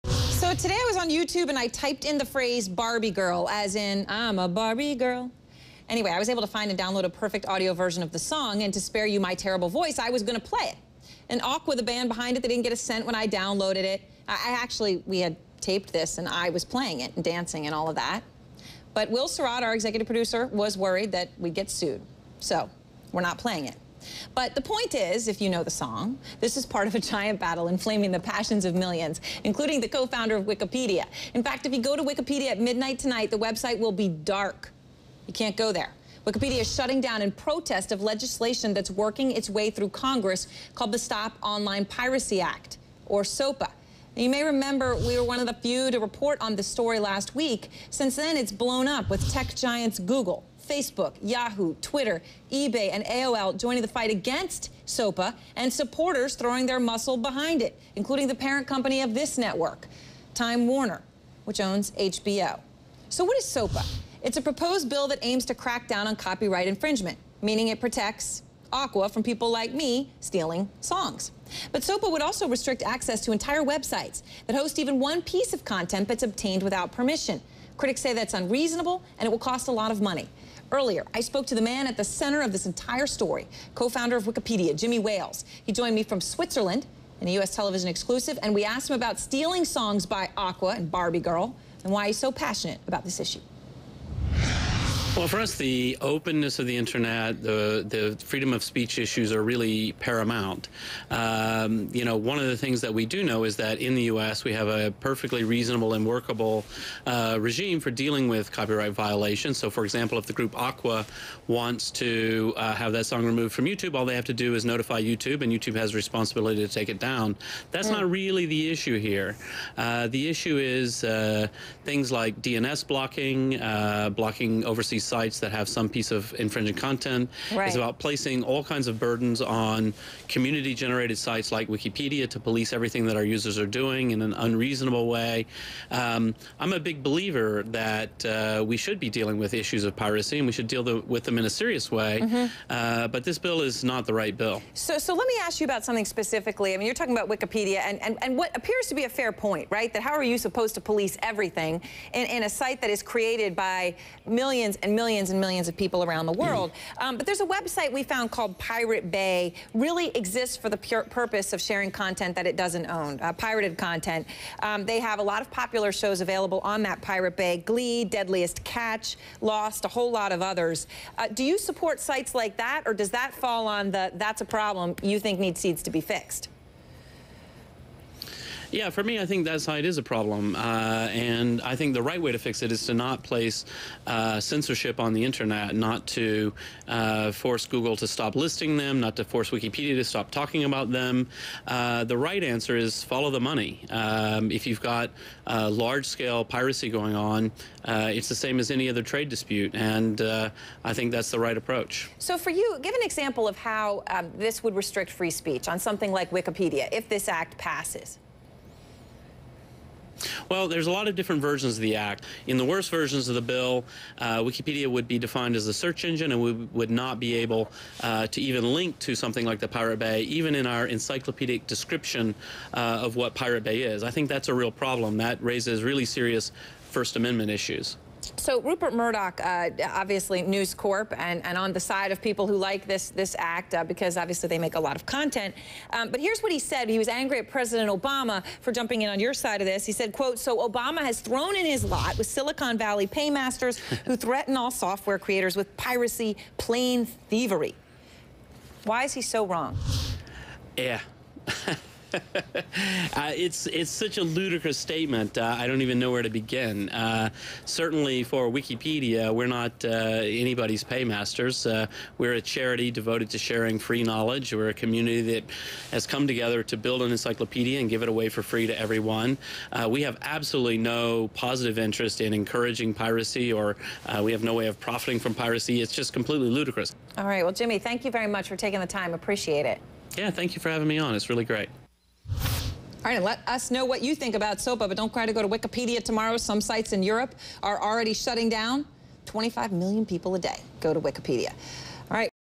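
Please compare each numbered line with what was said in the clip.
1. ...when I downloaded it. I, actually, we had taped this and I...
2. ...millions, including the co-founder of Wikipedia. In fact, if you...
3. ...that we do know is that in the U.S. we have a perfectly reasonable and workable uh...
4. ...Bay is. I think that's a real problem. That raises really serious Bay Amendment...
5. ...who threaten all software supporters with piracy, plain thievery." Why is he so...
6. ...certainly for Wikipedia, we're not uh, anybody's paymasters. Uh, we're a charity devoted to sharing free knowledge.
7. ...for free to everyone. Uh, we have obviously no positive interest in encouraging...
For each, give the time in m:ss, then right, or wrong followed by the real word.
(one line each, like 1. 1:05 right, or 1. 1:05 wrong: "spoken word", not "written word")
1. 0:13 right
2. 0:28 right
3. 1:42 right
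4. 3:43 wrong: "First", not "Bay"
5. 4:04 wrong: "creators", not "supporters"
6. 4:17 right
7. 4:28 wrong: "absolutely", not "obviously".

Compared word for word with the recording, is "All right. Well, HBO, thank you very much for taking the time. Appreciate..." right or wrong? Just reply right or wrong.
wrong.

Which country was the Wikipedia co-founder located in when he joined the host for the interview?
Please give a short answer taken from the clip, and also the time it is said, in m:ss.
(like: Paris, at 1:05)
Switzerland, at 1:26.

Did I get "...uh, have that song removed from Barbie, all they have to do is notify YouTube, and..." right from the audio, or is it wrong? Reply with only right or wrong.
wrong.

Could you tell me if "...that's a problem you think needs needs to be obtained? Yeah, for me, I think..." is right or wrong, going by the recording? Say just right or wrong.
wrong.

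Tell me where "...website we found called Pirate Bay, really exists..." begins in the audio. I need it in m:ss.
2:37.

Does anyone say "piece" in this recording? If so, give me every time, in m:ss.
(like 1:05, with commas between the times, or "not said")
1:15, 2:05.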